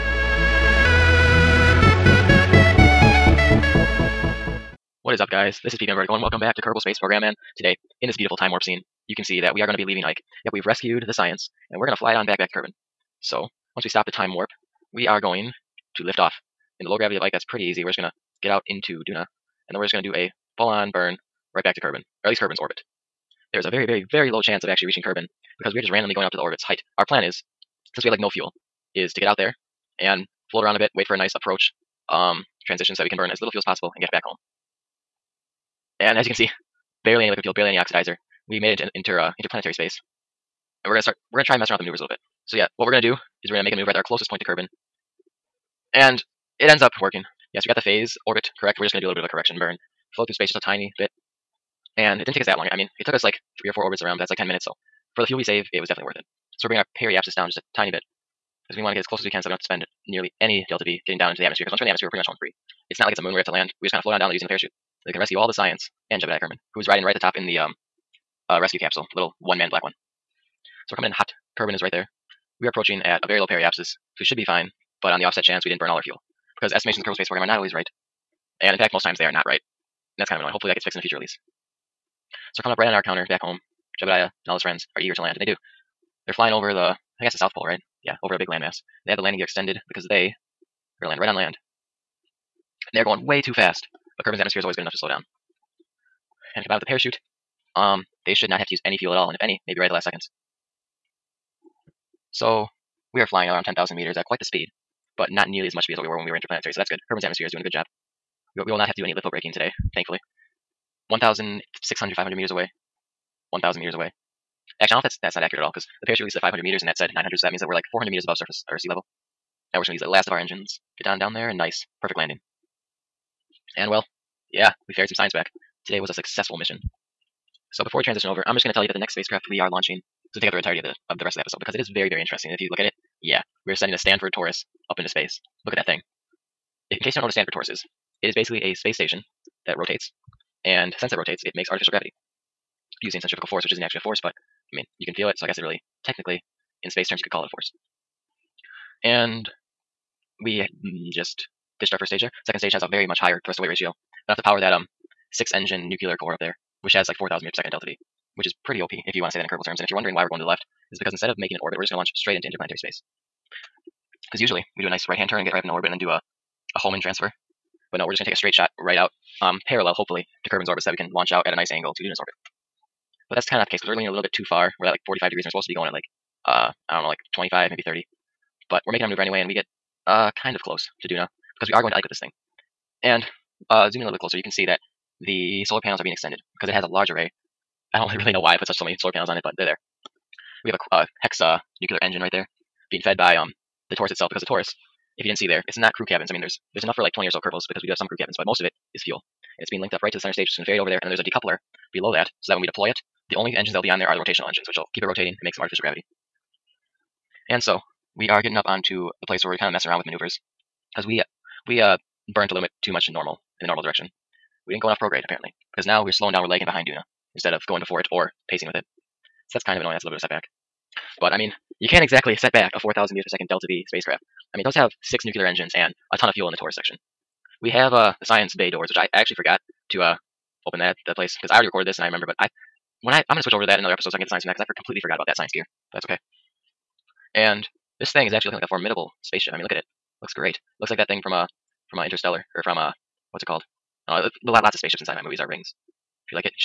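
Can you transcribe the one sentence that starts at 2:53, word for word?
But that's kind of not the case because we're leaning a little bit too far.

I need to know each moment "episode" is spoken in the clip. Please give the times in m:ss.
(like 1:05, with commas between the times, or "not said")
2:11, 3:53.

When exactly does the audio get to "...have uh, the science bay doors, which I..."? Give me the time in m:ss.
3:47.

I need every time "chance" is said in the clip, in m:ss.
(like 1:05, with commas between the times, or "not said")
0:24, 1:15.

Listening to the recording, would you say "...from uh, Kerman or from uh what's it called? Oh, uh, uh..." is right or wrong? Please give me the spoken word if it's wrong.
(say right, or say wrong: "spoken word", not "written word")
wrong: "Interstellar", not "Kerman".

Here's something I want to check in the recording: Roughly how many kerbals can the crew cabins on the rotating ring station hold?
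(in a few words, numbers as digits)
20.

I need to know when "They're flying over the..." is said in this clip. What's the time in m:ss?
1:26.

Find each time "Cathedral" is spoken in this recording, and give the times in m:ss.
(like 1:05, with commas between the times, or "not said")
not said.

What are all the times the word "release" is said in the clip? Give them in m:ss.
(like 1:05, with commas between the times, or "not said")
1:21, 1:56.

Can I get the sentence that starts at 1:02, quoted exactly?
It's not like it's a moon where we have to land.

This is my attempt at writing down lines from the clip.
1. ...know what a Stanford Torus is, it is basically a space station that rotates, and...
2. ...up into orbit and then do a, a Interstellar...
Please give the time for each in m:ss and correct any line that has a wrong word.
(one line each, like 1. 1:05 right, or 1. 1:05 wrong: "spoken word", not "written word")
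1. 2:17 right
2. 2:45 wrong: "Hohmann", not "Interstellar".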